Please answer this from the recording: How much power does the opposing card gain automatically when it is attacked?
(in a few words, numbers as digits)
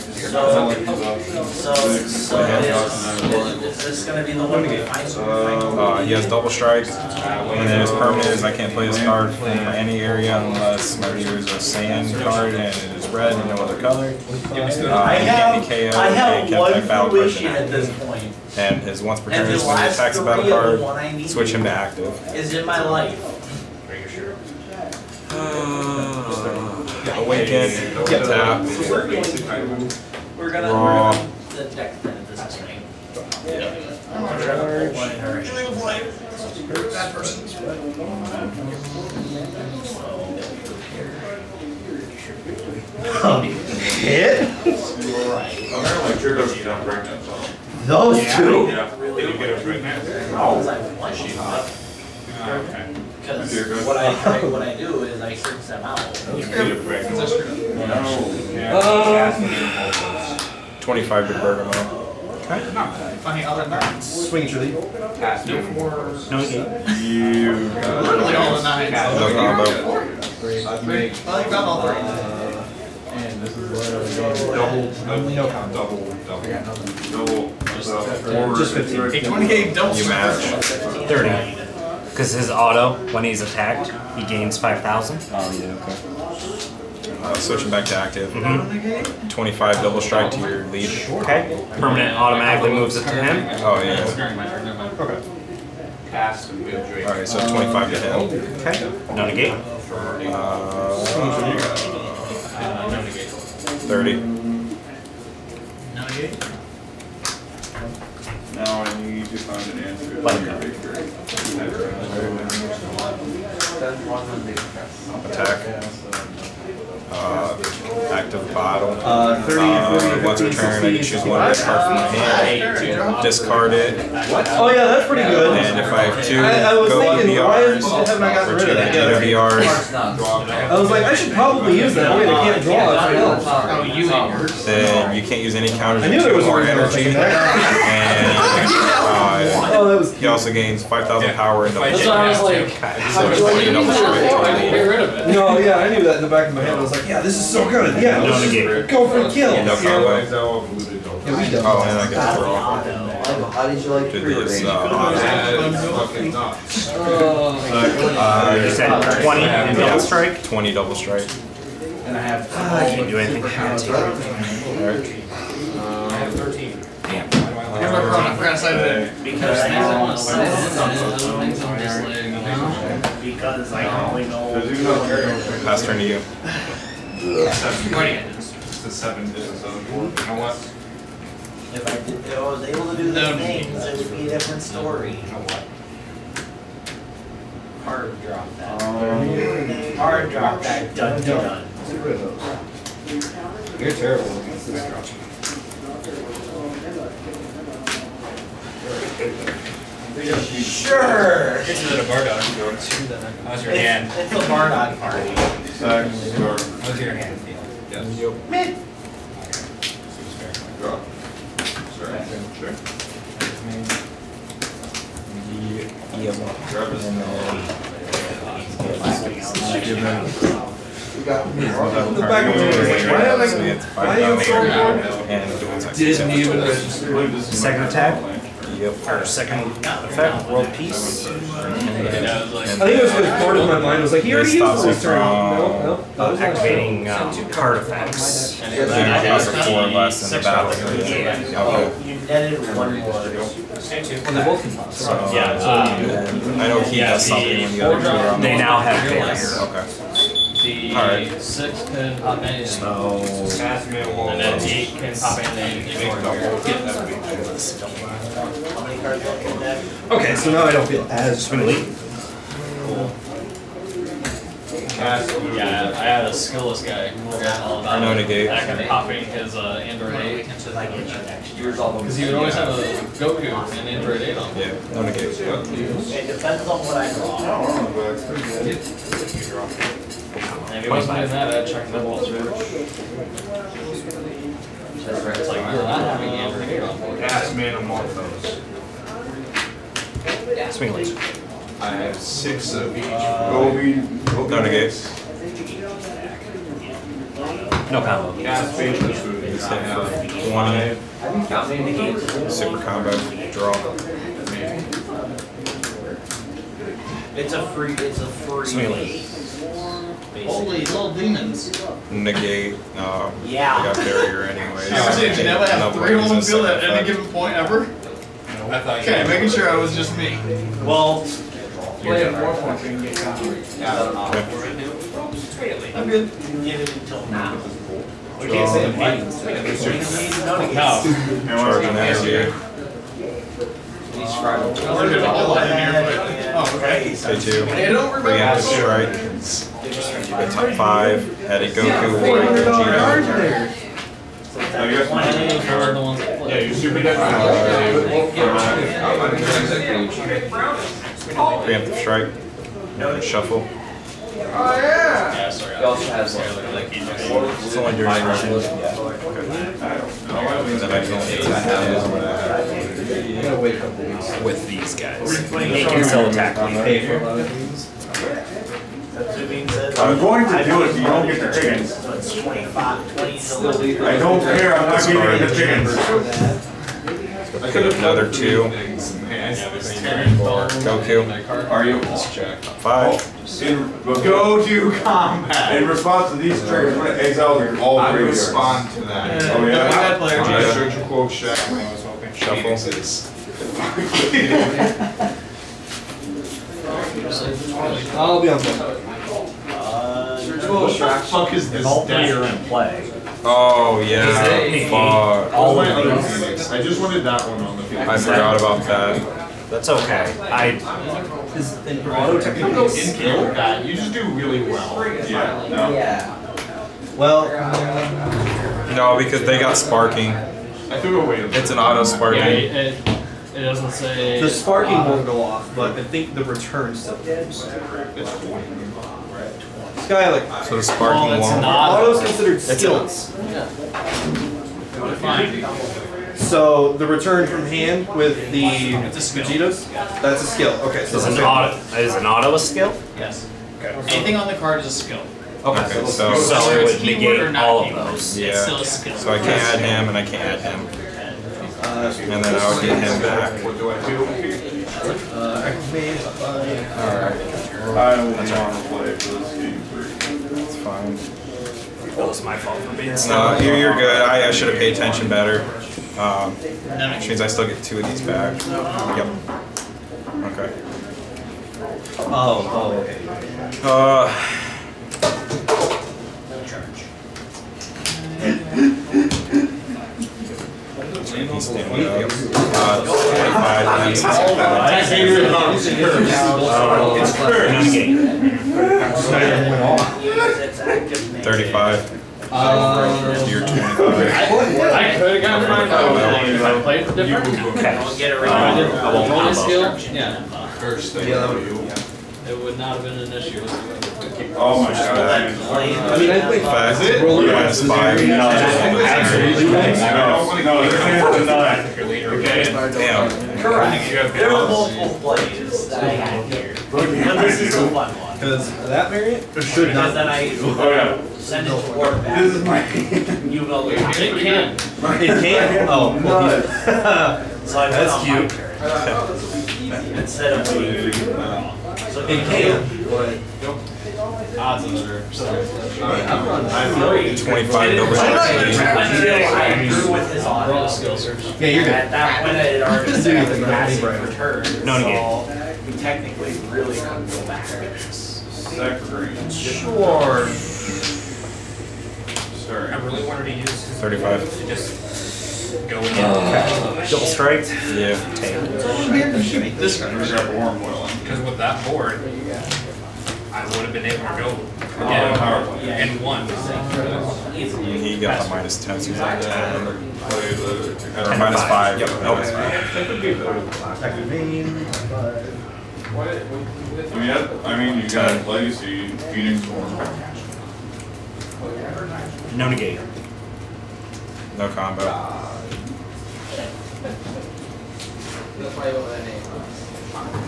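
5,000.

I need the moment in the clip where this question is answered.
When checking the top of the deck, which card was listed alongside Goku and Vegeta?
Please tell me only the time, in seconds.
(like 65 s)
342 s.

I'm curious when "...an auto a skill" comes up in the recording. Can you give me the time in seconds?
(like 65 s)
442 s.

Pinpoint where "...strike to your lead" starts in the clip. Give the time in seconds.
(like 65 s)
90 s.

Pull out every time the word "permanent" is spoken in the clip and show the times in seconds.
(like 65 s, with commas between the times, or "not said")
7 s, 91 s.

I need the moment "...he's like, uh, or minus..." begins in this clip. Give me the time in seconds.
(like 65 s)
569 s.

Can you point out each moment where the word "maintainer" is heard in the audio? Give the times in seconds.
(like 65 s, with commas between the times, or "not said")
not said.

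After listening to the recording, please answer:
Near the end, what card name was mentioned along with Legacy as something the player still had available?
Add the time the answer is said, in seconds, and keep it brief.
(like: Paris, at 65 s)
Phoenix Storm, at 579 s.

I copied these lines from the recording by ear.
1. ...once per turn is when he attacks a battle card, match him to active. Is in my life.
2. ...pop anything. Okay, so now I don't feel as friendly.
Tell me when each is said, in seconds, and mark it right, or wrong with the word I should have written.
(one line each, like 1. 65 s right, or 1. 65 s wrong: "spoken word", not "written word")
1. 19 s wrong: "switch", not "match"
2. 255 s right.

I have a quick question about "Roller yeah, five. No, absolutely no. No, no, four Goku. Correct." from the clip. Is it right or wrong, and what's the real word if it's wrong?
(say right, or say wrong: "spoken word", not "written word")
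wrong: "Okay", not "Goku".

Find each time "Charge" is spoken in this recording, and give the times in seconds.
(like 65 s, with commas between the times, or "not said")
330 s, 478 s.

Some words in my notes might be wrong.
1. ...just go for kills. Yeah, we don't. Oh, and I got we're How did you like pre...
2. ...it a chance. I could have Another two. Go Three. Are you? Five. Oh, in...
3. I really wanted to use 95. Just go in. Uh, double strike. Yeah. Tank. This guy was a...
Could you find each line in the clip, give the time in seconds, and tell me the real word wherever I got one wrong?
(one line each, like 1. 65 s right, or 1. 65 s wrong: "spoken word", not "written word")
1. 148 s right
2. 375 s wrong: "Goku", not "Three"
3. 552 s wrong: "35", not "95".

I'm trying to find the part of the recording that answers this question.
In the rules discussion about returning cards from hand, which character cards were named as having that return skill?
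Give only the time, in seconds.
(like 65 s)
438 s.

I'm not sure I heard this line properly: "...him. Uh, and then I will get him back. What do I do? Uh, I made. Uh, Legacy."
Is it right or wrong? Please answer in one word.
wrong.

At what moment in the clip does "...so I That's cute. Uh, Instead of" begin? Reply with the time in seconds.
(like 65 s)
527 s.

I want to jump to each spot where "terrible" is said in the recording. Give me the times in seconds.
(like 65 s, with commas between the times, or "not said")
193 s.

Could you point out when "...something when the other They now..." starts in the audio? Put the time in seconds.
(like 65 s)
247 s.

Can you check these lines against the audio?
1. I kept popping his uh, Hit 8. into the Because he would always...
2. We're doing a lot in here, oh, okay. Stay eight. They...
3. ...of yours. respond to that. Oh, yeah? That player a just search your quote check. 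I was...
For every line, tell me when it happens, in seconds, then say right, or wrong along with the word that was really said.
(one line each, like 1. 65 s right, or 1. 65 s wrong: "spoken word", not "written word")
1. 268 s wrong: "Android", not "Hit"
2. 334 s wrong: "two", not "eight"
3. 388 s right.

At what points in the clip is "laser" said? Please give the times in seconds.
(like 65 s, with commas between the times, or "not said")
290 s, 308 s.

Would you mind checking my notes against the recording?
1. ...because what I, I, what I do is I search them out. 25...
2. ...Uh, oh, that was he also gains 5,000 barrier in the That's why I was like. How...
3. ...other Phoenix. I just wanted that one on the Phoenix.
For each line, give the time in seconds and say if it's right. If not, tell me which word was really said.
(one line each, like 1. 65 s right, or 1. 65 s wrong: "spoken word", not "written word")
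1. 53 s right
2. 139 s wrong: "power", not "barrier"
3. 405 s right.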